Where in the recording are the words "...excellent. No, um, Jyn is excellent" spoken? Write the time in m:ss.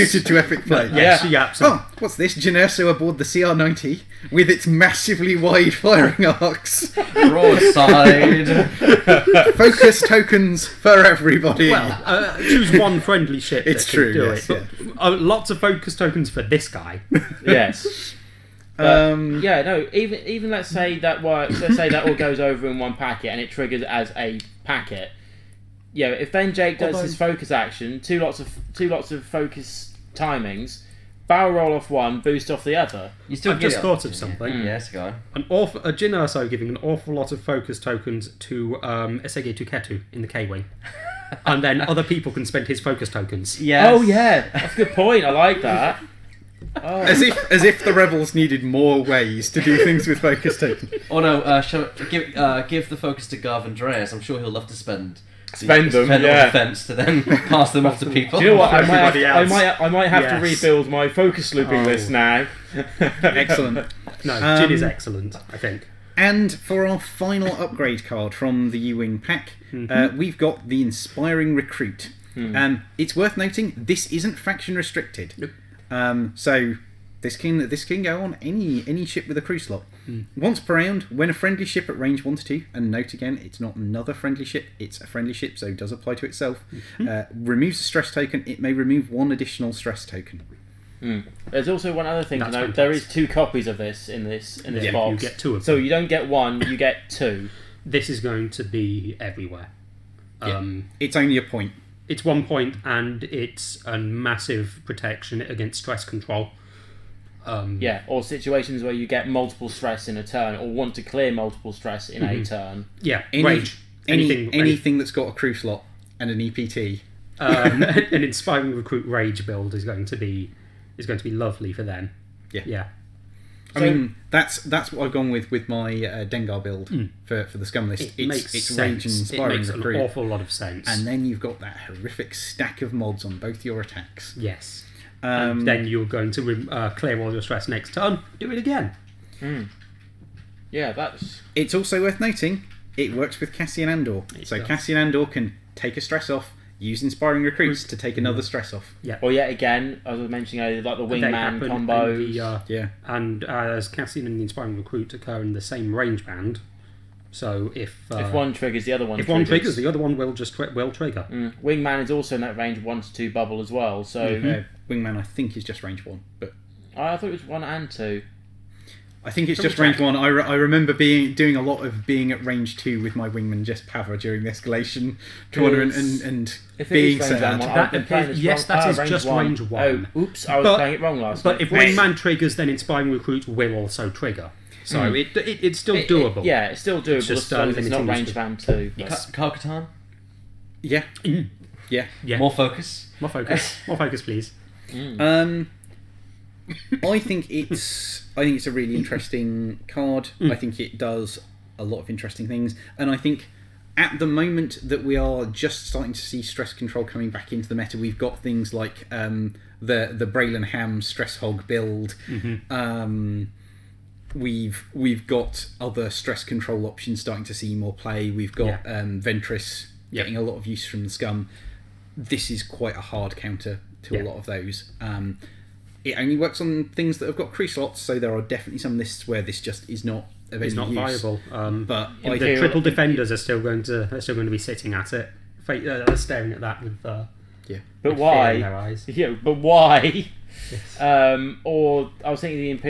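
1:02.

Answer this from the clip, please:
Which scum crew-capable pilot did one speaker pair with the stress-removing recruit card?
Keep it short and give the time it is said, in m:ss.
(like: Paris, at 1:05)
Dengar, at 2:06.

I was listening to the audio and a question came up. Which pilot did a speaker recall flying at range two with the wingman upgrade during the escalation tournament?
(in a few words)
Jess Pava.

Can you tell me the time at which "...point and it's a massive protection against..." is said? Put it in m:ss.
1:42.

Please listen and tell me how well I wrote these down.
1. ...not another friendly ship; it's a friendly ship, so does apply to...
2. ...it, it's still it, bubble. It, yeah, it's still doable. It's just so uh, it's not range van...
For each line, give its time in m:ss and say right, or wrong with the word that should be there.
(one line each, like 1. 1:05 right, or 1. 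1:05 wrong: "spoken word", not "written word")
1. 1:23 right
2. 3:05 wrong: "doable", not "bubble".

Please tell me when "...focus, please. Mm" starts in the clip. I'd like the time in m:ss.
3:13.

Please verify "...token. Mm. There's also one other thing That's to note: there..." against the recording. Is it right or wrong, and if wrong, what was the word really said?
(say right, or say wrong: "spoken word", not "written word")
right.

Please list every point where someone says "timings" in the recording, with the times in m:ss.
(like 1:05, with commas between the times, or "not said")
0:30.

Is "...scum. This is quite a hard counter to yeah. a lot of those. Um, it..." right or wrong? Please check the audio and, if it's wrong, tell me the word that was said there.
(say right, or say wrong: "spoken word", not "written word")
right.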